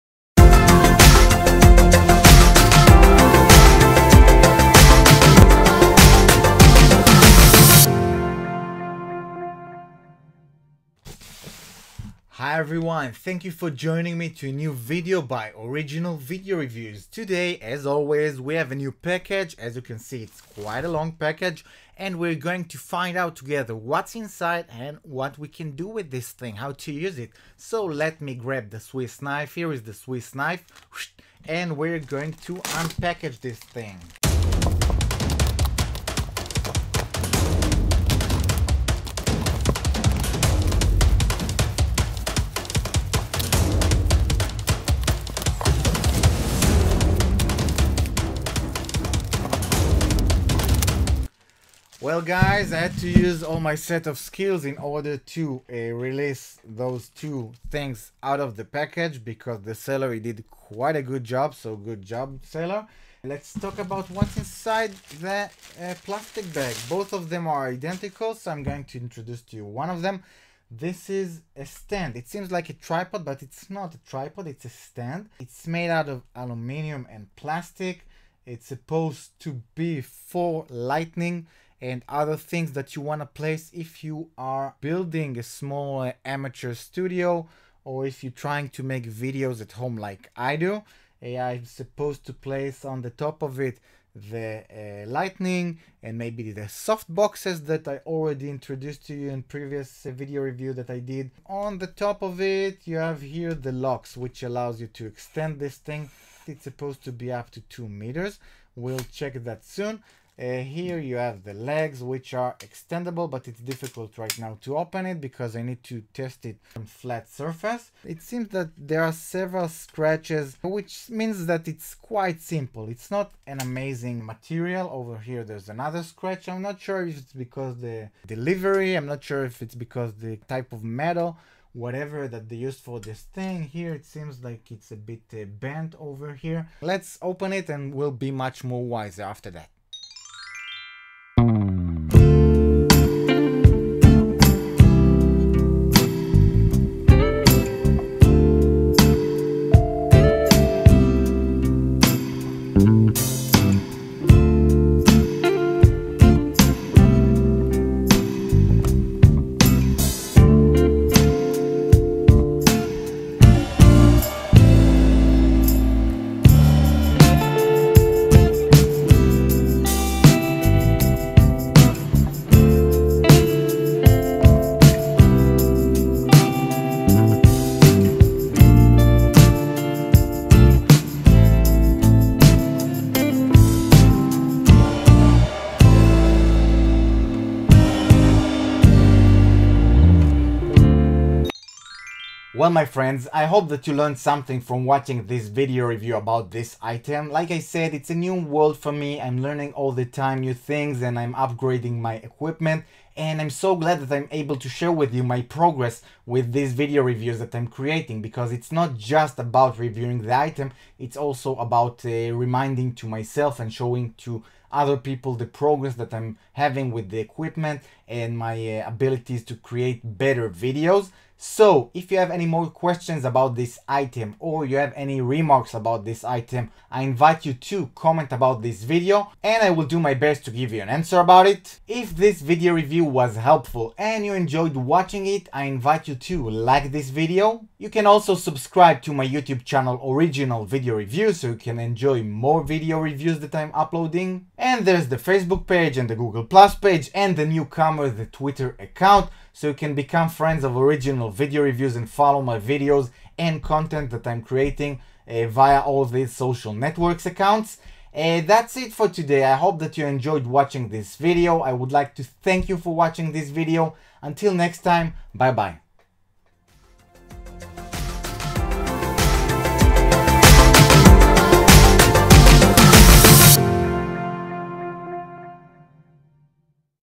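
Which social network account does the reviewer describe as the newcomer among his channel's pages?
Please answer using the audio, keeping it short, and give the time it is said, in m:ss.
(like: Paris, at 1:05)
Twitter, at 4:08.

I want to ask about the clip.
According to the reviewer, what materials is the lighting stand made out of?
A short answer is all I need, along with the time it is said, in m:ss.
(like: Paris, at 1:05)
aluminium and plastic, at 1:16.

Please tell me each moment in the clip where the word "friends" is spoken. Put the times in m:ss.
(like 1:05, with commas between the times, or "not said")
3:12, 4:10.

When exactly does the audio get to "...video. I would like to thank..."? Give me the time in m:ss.
4:21.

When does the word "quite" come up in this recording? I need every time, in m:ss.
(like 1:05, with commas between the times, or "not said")
0:20, 1:00, 2:01.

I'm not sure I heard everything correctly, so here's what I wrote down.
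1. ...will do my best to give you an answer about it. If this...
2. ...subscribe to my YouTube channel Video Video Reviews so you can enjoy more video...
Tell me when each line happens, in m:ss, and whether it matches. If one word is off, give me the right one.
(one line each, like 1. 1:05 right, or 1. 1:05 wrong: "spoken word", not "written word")
1. 3:49 right
2. 3:58 wrong: "Original", not "Video".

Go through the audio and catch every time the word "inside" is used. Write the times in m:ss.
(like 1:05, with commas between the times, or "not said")
0:24, 1:04.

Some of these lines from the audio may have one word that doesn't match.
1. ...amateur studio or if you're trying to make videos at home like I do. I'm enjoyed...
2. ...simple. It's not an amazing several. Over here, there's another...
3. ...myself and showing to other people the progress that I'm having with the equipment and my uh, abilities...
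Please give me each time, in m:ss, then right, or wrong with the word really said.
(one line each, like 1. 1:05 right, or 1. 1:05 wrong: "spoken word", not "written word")
1. 1:26 wrong: "supposed", not "enjoyed"
2. 2:02 wrong: "material", not "several"
3. 3:33 right.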